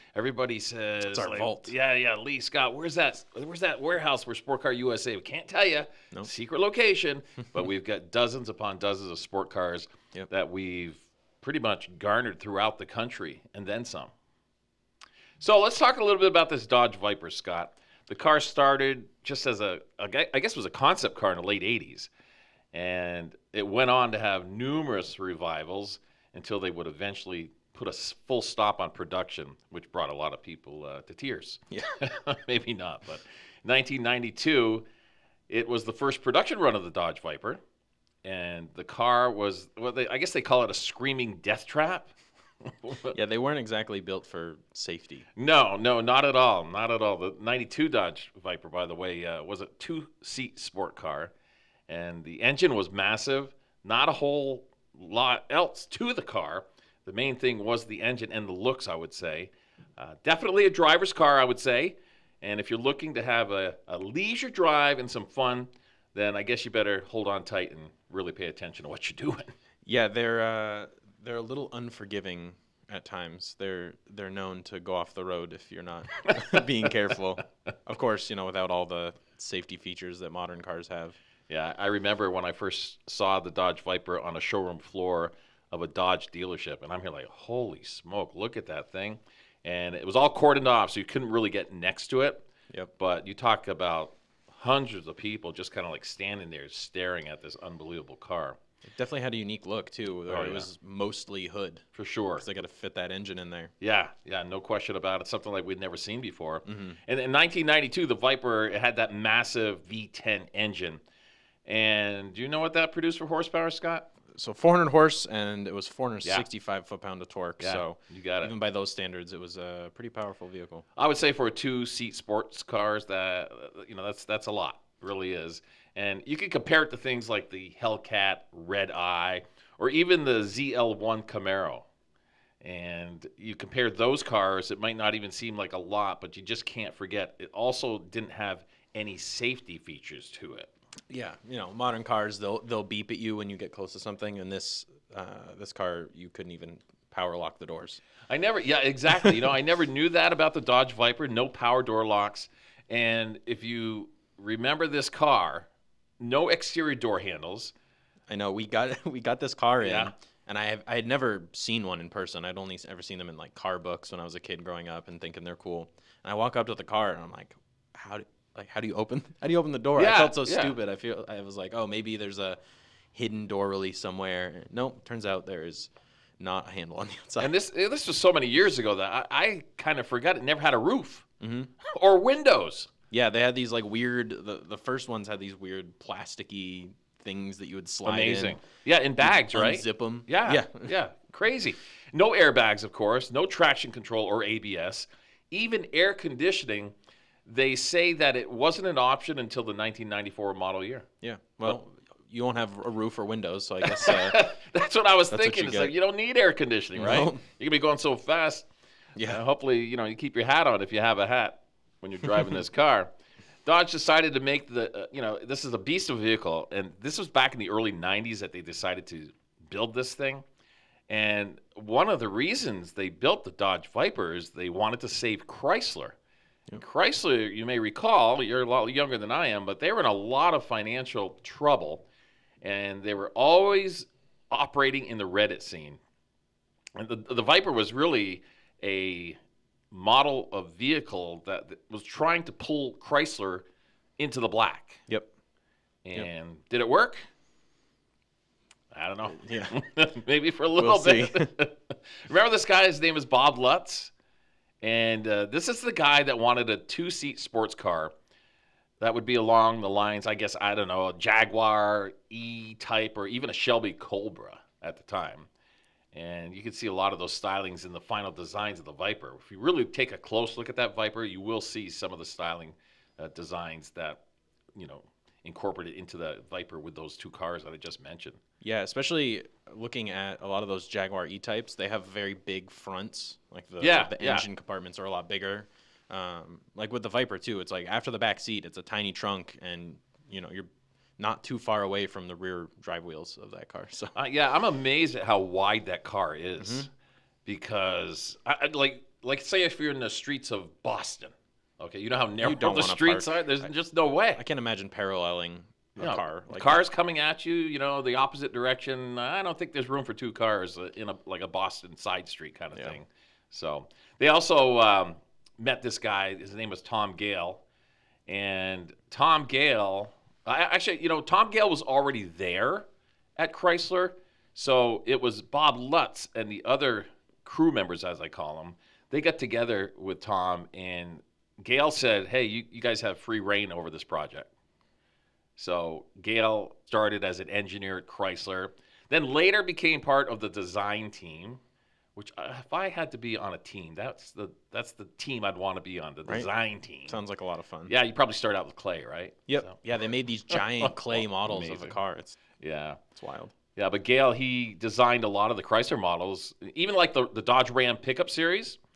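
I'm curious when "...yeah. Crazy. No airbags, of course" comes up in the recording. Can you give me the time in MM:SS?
03:10.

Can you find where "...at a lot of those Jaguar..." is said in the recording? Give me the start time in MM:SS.
04:40.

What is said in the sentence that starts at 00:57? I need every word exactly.
The main thing was the engine and the looks, I would say.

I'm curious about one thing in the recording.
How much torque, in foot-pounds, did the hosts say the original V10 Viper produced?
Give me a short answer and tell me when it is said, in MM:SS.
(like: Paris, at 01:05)
465, at 01:55.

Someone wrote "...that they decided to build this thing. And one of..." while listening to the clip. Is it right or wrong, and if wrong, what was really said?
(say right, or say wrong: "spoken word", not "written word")
right.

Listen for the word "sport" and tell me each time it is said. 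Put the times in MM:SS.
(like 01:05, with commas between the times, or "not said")
00:04, 00:09, 00:50, 02:02, 04:17.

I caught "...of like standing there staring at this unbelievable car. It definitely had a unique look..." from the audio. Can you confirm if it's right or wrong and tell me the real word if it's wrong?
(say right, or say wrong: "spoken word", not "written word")
right.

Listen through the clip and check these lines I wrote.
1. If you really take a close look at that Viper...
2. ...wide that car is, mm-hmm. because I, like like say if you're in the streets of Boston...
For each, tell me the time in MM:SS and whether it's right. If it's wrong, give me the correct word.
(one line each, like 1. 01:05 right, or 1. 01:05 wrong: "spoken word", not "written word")
1. 04:29 right
2. 04:55 right.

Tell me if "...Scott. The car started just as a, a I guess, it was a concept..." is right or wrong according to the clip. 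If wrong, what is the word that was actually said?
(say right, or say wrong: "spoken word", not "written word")
right.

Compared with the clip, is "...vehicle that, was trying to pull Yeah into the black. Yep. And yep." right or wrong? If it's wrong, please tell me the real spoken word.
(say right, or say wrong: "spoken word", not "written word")
wrong: "Chrysler", not "Yeah".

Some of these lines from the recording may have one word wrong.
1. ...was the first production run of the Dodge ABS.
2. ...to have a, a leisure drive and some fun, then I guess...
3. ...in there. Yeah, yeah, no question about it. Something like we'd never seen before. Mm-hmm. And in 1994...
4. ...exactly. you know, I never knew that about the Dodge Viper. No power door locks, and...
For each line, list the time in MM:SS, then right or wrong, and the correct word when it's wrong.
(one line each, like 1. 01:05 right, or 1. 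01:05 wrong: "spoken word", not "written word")
1. 00:35 wrong: "Viper", not "ABS"
2. 01:03 right
3. 01:43 wrong: "1992", not "1994"
4. 02:28 right.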